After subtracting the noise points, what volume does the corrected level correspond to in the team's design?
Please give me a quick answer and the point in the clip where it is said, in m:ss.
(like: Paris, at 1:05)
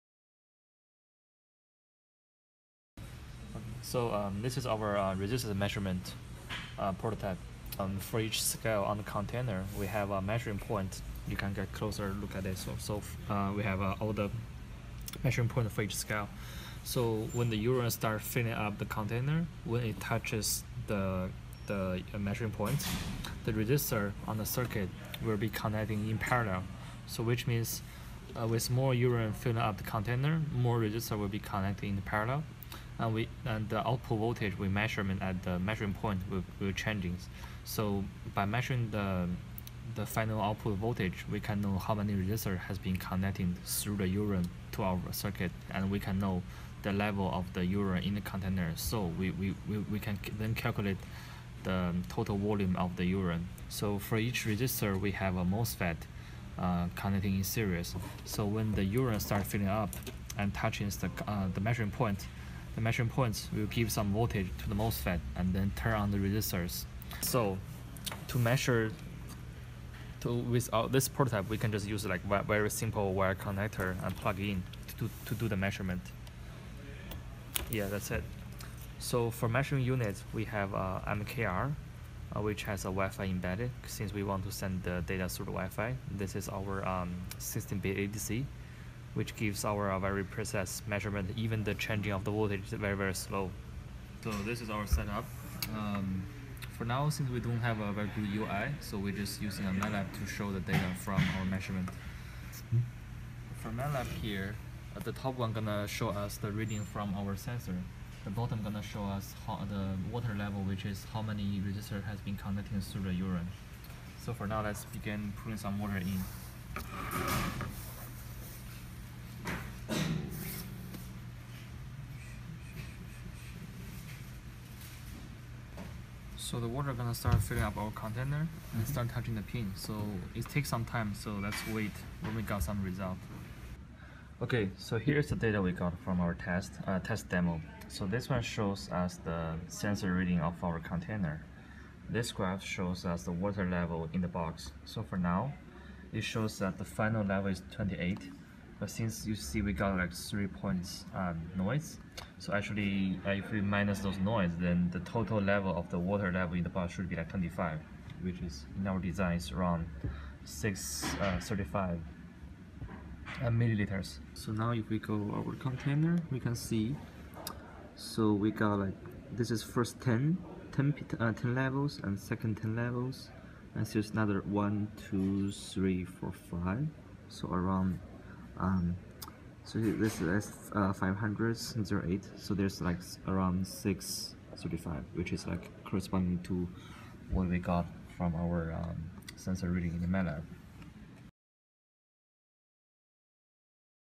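635 milliliters, at 2:40.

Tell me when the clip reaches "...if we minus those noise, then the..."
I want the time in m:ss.
2:33.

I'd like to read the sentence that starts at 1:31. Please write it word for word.
Even the changing of the voltage is very, very slow.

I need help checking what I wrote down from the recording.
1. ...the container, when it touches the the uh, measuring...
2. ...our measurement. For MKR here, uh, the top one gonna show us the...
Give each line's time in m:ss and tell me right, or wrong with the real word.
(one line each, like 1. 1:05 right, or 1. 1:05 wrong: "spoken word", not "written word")
1. 0:18 right
2. 1:41 wrong: "MATLAB", not "MKR".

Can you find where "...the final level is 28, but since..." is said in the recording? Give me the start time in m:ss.
2:26.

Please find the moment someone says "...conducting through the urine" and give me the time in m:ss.
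1:52.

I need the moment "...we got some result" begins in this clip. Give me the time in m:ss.
2:12.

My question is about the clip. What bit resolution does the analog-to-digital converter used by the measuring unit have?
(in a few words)
16-bit.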